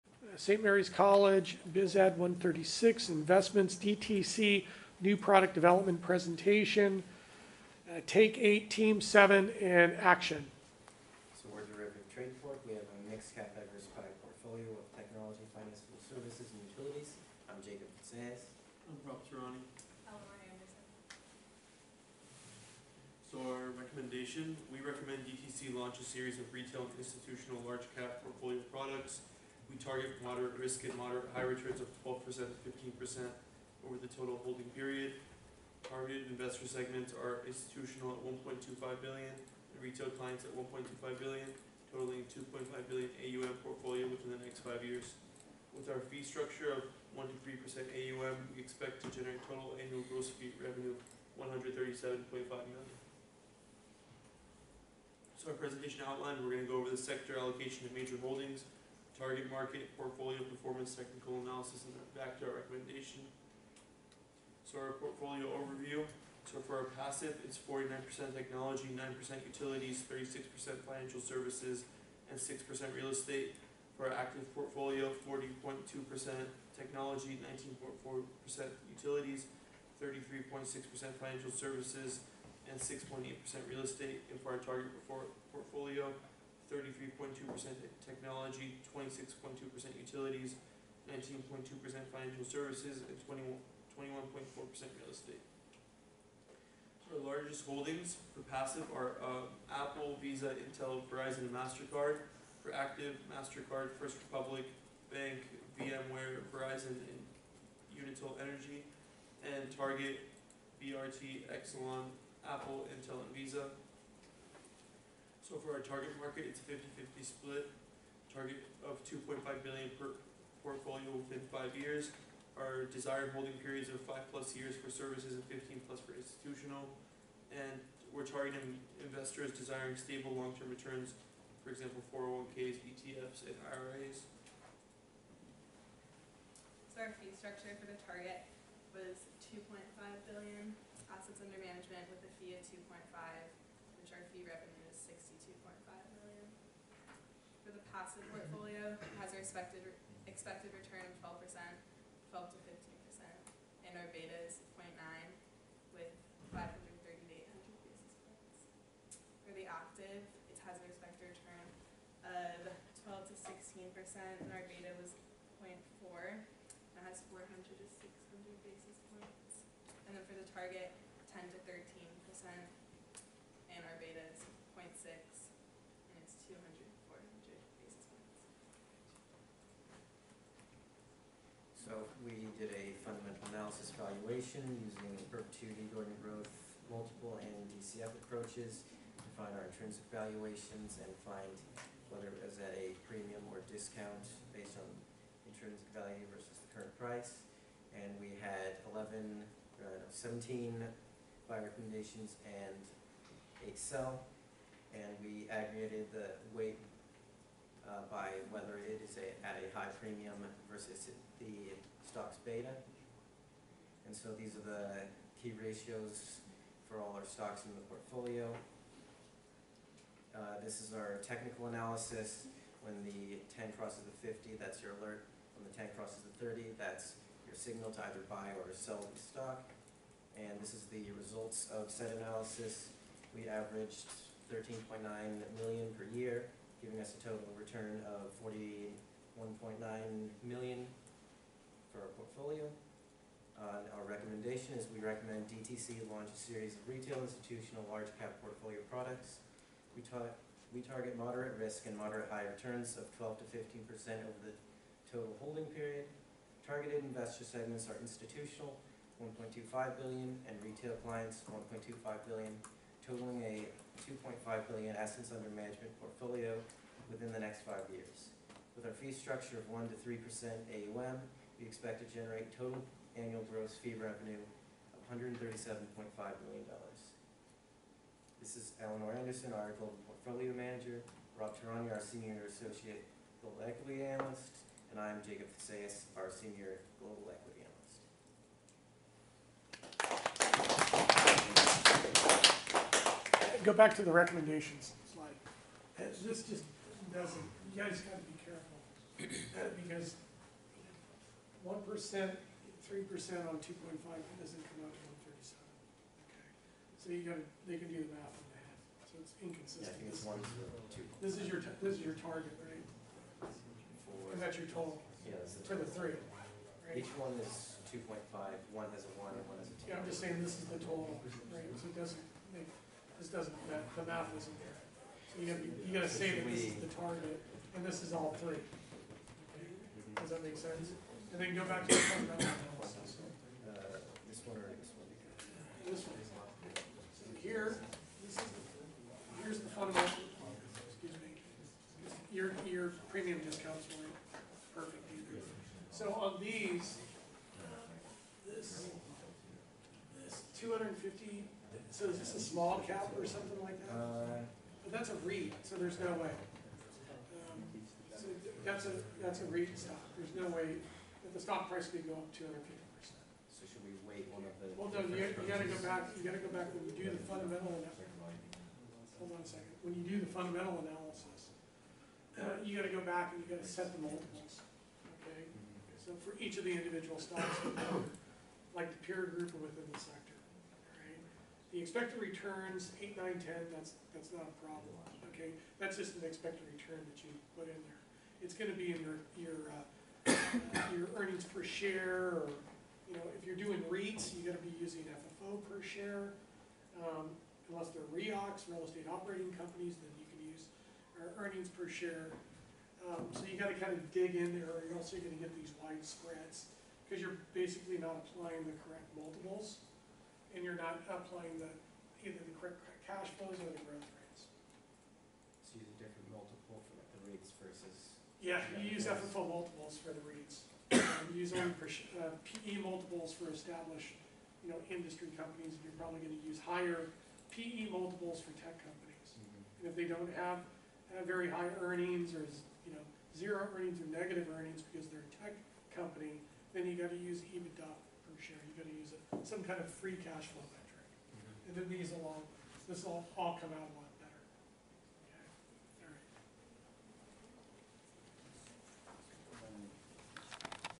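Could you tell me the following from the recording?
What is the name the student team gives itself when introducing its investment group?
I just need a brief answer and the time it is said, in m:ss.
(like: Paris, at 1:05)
Derivative Trade Fork, at 0:11.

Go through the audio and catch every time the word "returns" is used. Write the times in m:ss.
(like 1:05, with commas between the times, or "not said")
0:31, 2:10, 2:30, 2:41, 3:57, 4:12, 6:22, 6:26.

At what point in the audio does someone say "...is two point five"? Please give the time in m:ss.
5:17.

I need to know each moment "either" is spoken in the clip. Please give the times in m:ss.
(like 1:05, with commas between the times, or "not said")
3:48, 5:45, 6:52.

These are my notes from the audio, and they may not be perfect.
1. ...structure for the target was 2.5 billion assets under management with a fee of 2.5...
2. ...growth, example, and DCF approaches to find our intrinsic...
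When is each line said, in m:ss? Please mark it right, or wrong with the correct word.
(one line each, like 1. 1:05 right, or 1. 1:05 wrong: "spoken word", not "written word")
1. 2:17 right
2. 3:06 wrong: "multiple", not "example".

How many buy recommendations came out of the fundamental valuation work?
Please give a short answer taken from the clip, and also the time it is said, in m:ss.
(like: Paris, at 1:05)
17, at 3:20.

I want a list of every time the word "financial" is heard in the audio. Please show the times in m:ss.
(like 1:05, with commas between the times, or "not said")
0:15, 1:10, 1:21, 1:32.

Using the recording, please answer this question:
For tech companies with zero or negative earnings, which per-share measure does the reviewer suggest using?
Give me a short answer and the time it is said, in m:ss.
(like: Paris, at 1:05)
EBITDA per share, at 7:17.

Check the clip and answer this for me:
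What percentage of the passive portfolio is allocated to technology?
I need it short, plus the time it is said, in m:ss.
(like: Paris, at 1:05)
49%, at 1:07.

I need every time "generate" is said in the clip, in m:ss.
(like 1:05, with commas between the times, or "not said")
0:49, 4:32.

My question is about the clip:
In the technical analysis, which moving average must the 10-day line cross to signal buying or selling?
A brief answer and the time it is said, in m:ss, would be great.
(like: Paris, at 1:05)
30, at 3:46.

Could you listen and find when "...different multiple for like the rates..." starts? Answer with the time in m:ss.
6:55.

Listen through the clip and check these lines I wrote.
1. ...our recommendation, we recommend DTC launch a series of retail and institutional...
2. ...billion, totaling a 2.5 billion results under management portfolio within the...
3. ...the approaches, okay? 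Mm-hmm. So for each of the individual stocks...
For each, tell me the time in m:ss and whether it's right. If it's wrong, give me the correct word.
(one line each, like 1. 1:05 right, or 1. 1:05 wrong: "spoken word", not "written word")
1. 0:23 right
2. 4:22 wrong: "assets", not "results"
3. 6:13 wrong: "multiples", not "approaches".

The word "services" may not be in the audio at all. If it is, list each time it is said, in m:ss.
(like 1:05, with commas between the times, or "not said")
0:16, 1:11, 1:21, 1:32, 2:04.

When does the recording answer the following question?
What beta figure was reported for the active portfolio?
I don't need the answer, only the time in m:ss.
2:45.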